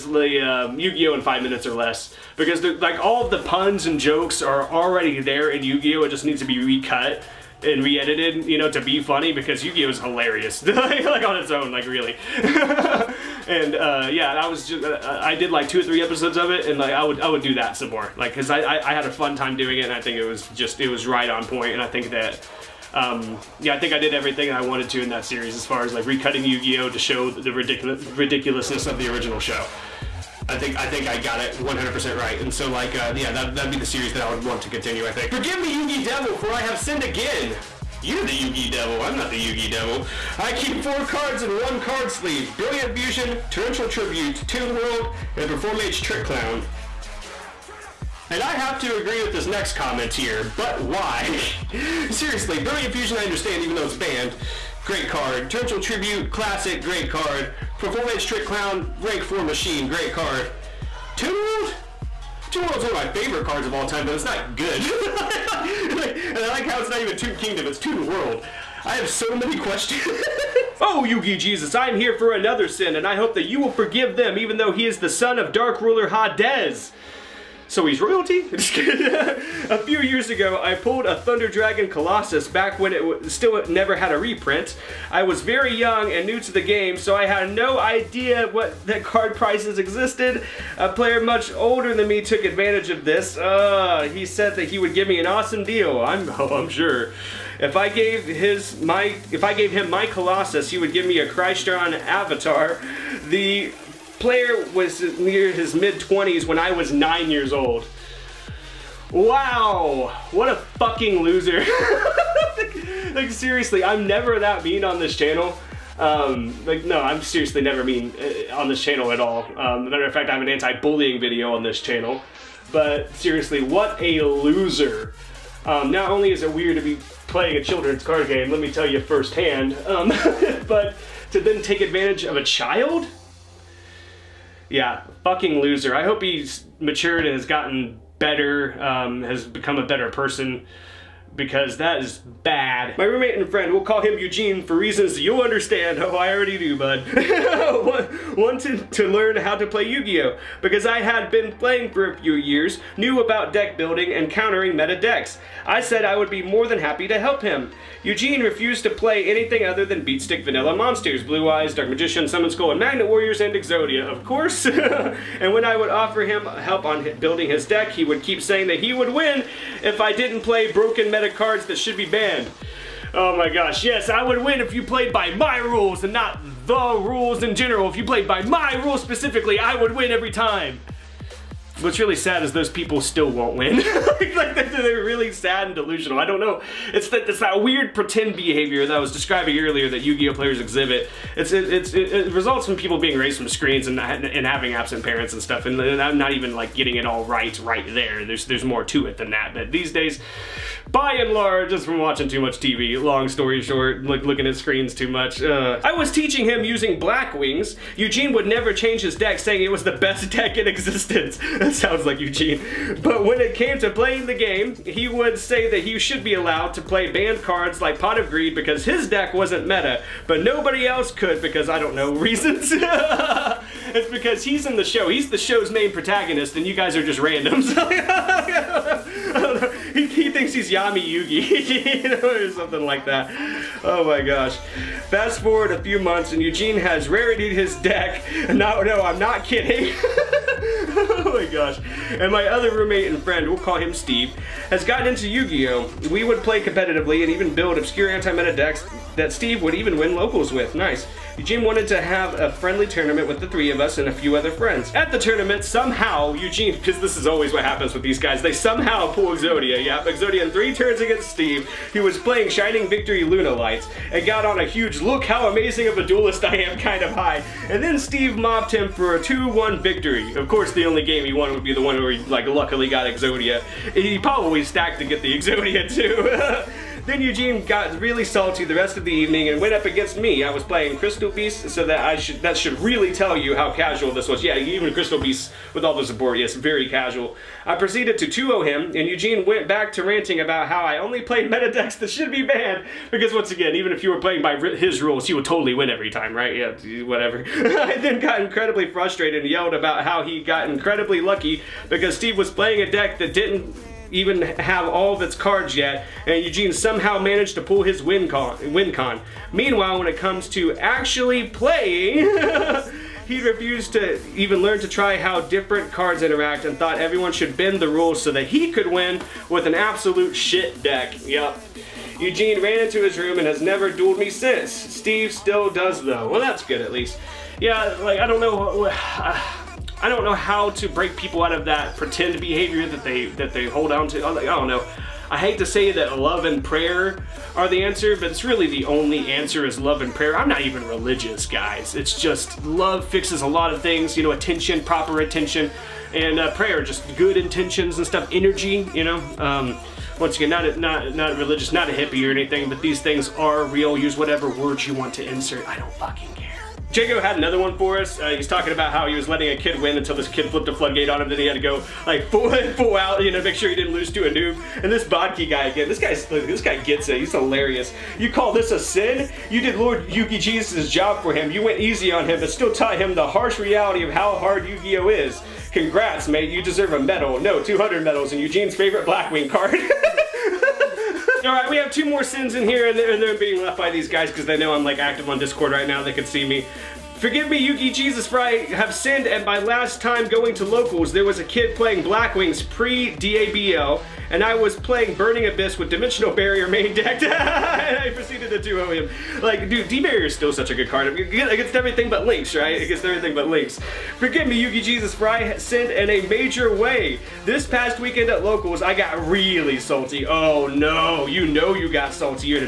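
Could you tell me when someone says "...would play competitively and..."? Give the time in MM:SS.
04:06.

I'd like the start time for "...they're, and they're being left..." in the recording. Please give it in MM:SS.
06:22.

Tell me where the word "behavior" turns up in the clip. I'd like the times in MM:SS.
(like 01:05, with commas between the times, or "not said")
03:08, 05:32.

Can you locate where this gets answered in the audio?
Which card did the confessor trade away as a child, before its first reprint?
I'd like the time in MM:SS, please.
01:21.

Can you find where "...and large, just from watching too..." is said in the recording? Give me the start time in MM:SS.
03:21.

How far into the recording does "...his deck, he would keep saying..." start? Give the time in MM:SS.
02:47.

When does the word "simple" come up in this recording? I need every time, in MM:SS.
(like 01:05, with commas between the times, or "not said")
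not said.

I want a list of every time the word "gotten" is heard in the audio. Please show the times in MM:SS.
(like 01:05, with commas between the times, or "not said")
02:17, 04:04.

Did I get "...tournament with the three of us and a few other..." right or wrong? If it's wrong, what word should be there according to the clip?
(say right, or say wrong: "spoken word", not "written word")
right.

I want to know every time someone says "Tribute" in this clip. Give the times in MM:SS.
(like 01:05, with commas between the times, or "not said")
00:43, 00:55.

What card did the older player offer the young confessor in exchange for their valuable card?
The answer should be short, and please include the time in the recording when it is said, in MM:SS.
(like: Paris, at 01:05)
Crystron Avatar, at 01:41.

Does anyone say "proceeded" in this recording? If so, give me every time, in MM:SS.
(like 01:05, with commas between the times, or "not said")
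04:47, 06:38.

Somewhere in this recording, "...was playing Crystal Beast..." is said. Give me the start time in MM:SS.
04:40.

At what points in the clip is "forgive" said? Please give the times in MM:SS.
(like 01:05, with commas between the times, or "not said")
00:35, 01:13, 06:27, 06:44.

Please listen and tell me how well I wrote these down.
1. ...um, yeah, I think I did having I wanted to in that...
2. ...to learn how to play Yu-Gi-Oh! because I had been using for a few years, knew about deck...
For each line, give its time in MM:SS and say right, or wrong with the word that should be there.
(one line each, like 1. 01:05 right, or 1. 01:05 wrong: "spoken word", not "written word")
1. 00:22 wrong: "everything", not "having"
2. 02:28 wrong: "playing", not "using".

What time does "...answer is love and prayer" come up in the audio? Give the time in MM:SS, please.
05:39.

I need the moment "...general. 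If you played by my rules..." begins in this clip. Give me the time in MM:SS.
02:57.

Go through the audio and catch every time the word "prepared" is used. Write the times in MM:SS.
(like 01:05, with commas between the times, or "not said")
not said.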